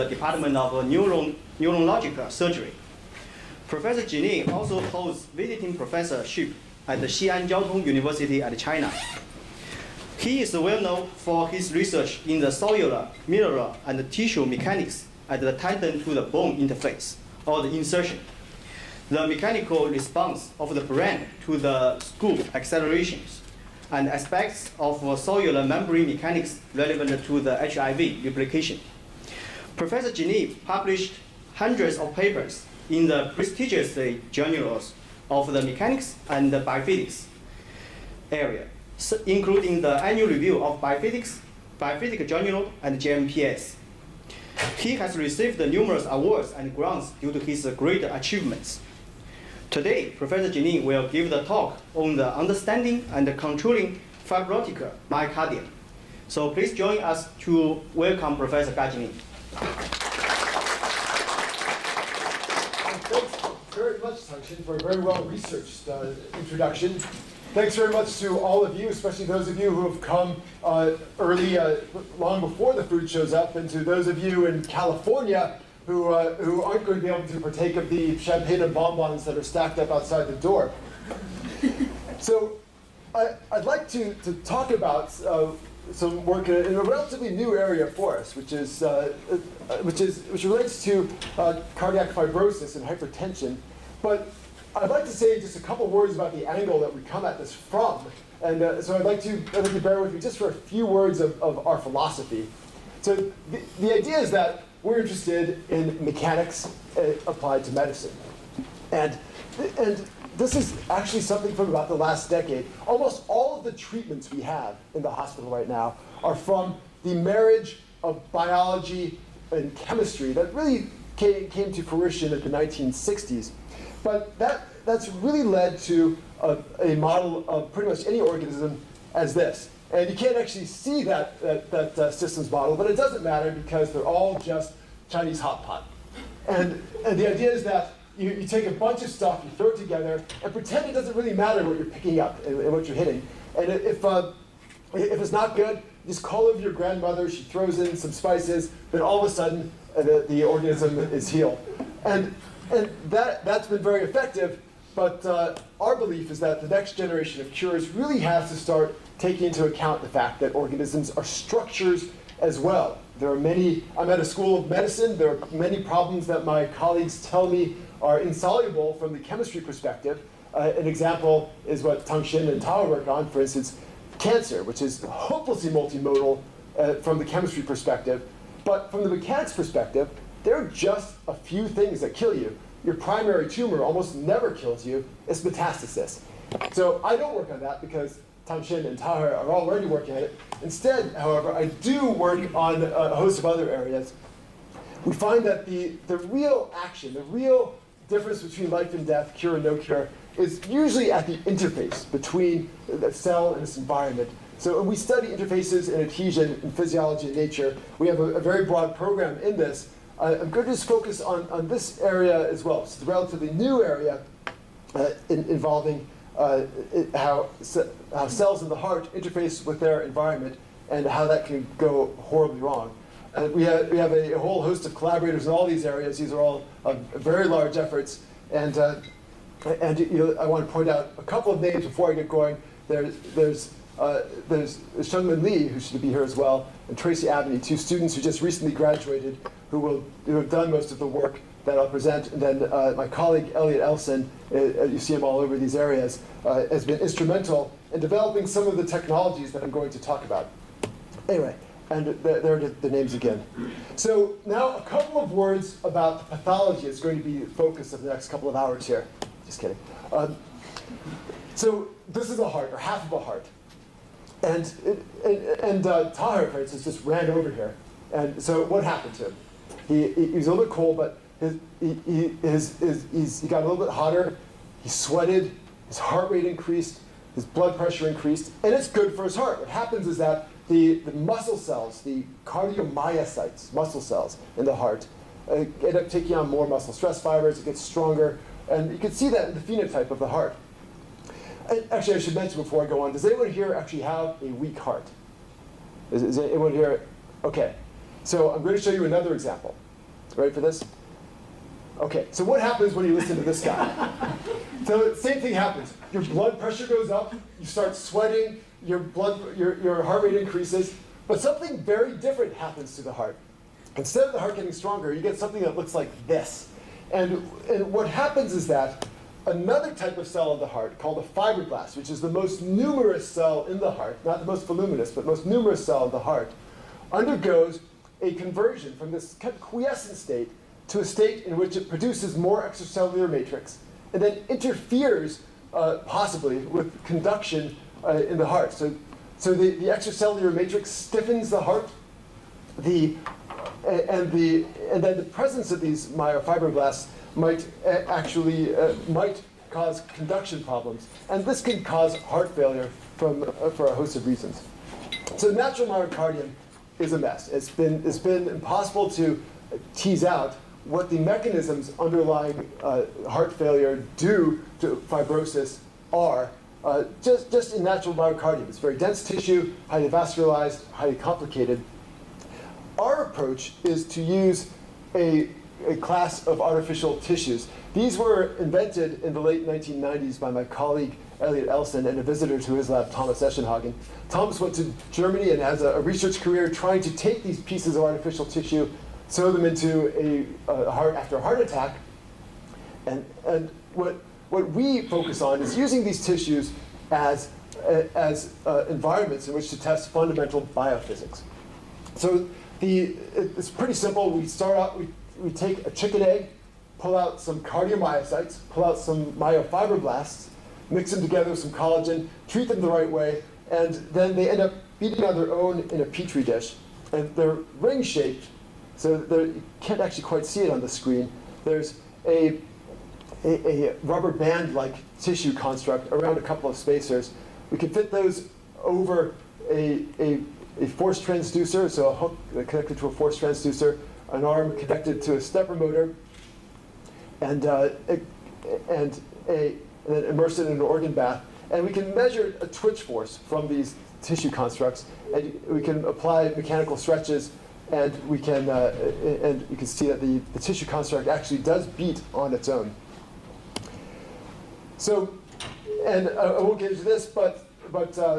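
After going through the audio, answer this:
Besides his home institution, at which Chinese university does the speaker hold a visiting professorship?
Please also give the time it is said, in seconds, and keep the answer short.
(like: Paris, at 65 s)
Xi'an Jiao Tong University, at 7 s.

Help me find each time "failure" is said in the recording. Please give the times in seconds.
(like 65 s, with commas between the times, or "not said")
352 s, 363 s.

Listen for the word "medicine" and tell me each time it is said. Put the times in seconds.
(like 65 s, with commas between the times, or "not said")
107 s, 164 s.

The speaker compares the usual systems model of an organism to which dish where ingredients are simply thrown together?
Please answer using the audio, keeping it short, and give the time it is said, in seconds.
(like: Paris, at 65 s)
Chinese hot pot, at 135 s.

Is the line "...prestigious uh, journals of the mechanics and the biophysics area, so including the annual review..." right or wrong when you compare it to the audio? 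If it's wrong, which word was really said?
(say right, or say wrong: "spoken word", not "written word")
right.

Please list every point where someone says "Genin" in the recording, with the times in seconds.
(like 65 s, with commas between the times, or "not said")
4 s, 30 s, 50 s, 58 s.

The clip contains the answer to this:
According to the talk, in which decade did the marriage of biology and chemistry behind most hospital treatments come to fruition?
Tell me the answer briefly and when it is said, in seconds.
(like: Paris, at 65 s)
1960s, at 122 s.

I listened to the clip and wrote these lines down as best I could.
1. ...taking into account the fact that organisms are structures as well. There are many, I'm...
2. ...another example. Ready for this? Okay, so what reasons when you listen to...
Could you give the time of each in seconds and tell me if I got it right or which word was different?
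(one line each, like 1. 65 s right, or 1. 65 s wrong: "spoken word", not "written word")
1. 159 s right
2. 299 s wrong: "happens", not "reasons".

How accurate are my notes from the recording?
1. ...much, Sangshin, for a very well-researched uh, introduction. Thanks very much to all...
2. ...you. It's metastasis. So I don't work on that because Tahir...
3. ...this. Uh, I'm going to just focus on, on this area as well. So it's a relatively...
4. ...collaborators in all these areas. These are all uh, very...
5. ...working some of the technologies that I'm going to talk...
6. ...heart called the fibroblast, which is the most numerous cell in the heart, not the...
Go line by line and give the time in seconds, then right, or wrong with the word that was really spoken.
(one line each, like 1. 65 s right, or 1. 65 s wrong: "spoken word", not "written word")
1. 63 s right
2. 184 s wrong: "Shin", not "Tahir"
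3. 209 s right
4. 224 s right
5. 247 s wrong: "developing", not "working"
6. 320 s right.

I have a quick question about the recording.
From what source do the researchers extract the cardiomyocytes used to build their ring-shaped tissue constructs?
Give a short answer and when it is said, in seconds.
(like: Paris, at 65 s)
A chicken egg, at 405 s.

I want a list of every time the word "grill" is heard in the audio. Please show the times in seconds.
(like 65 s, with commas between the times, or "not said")
not said.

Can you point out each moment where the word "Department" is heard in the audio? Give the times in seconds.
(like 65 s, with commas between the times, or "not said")
0 s.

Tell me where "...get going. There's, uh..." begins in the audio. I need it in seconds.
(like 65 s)
232 s.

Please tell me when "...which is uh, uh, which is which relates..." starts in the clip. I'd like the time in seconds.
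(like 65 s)
88 s.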